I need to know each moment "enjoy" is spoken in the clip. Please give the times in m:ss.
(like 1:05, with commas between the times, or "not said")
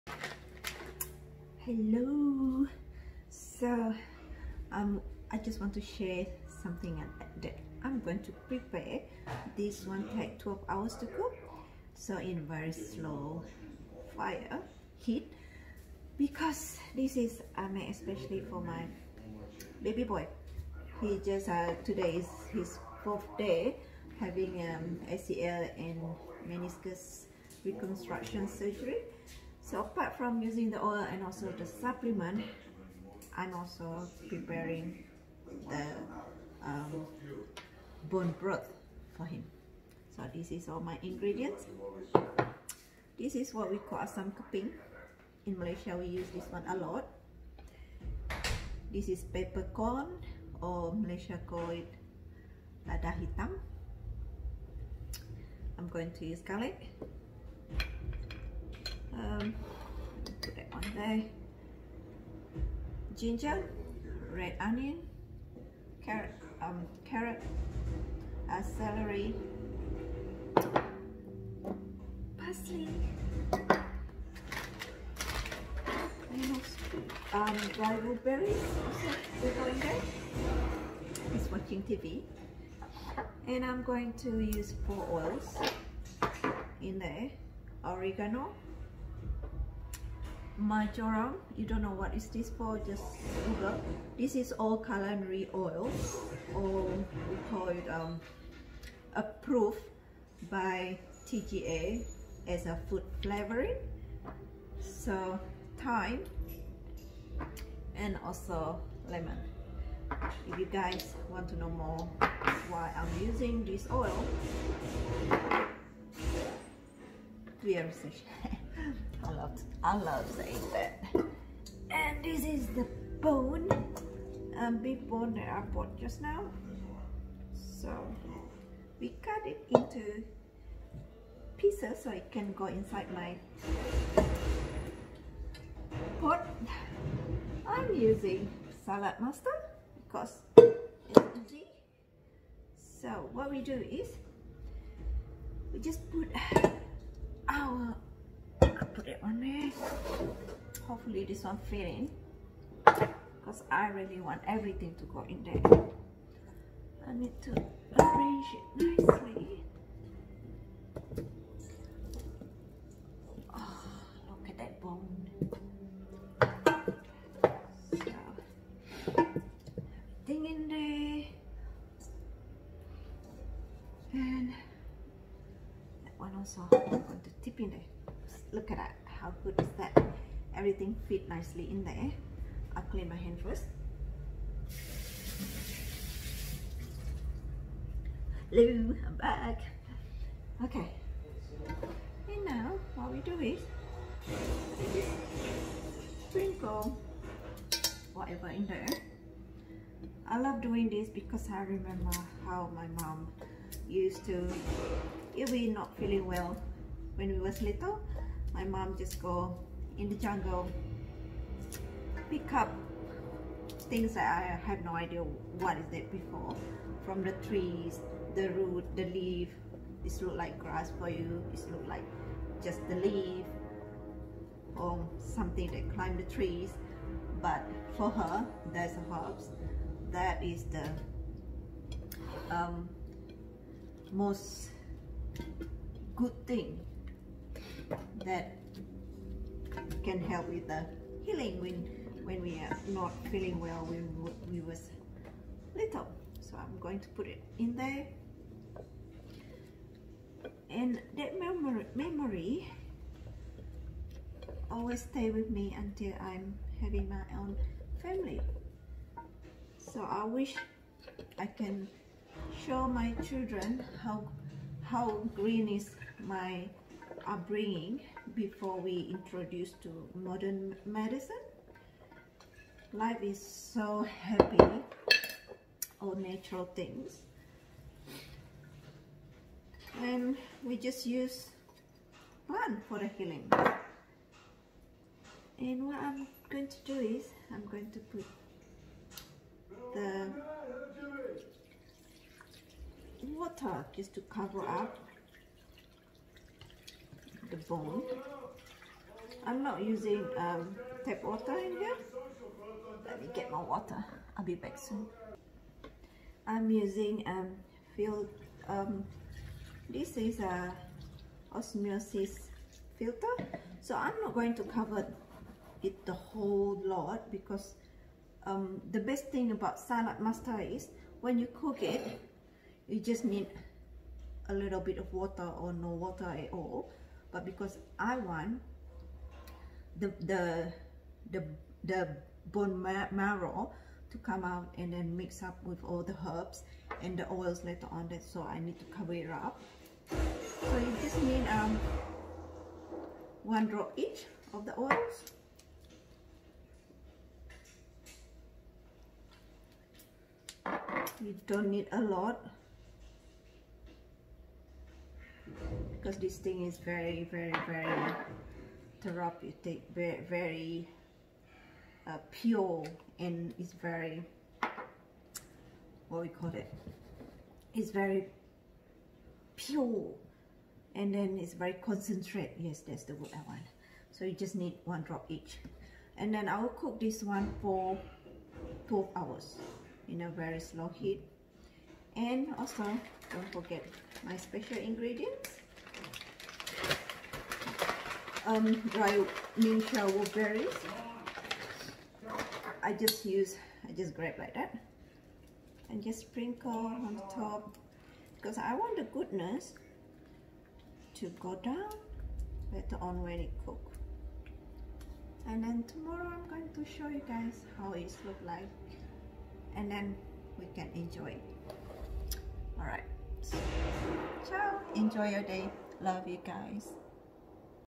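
6:50, 6:54.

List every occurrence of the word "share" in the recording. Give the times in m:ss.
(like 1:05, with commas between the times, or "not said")
0:05.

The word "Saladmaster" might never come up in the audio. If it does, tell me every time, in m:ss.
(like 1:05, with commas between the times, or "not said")
2:18, 5:19.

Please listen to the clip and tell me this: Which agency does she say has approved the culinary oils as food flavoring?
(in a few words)
TGA.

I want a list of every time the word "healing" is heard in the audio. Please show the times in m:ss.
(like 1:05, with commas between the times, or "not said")
4:01, 4:43.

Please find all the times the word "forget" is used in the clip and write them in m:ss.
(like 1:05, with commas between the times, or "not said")
6:23.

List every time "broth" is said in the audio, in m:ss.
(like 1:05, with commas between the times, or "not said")
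0:38.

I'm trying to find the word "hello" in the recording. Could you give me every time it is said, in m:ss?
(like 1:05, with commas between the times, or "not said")
0:01, 3:08.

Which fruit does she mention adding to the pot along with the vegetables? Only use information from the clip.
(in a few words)
blueberries.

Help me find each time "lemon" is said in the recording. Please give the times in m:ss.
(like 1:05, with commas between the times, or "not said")
1:49.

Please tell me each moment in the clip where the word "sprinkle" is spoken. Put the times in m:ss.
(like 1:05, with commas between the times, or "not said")
3:16, 6:36.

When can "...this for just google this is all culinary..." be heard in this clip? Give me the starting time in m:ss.
1:32.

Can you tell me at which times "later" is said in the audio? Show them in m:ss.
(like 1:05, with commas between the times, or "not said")
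5:37, 6:42.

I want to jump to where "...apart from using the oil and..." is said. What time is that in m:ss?
0:29.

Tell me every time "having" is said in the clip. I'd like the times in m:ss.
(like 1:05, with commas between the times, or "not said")
0:24, 4:16.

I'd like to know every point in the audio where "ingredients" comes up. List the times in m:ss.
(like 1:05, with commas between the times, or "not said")
0:41, 6:24.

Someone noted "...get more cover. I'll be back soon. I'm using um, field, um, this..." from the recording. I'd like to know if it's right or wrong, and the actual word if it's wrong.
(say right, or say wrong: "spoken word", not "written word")
wrong: "water", not "cover".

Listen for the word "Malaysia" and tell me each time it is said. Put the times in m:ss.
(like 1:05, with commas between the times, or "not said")
0:45, 0:50.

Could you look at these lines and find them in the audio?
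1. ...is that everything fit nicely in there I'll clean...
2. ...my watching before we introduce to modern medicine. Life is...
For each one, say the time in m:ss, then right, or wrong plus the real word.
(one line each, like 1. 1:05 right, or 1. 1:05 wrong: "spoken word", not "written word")
1. 2:59 right
2. 4:26 wrong: "upbringing", not "watching".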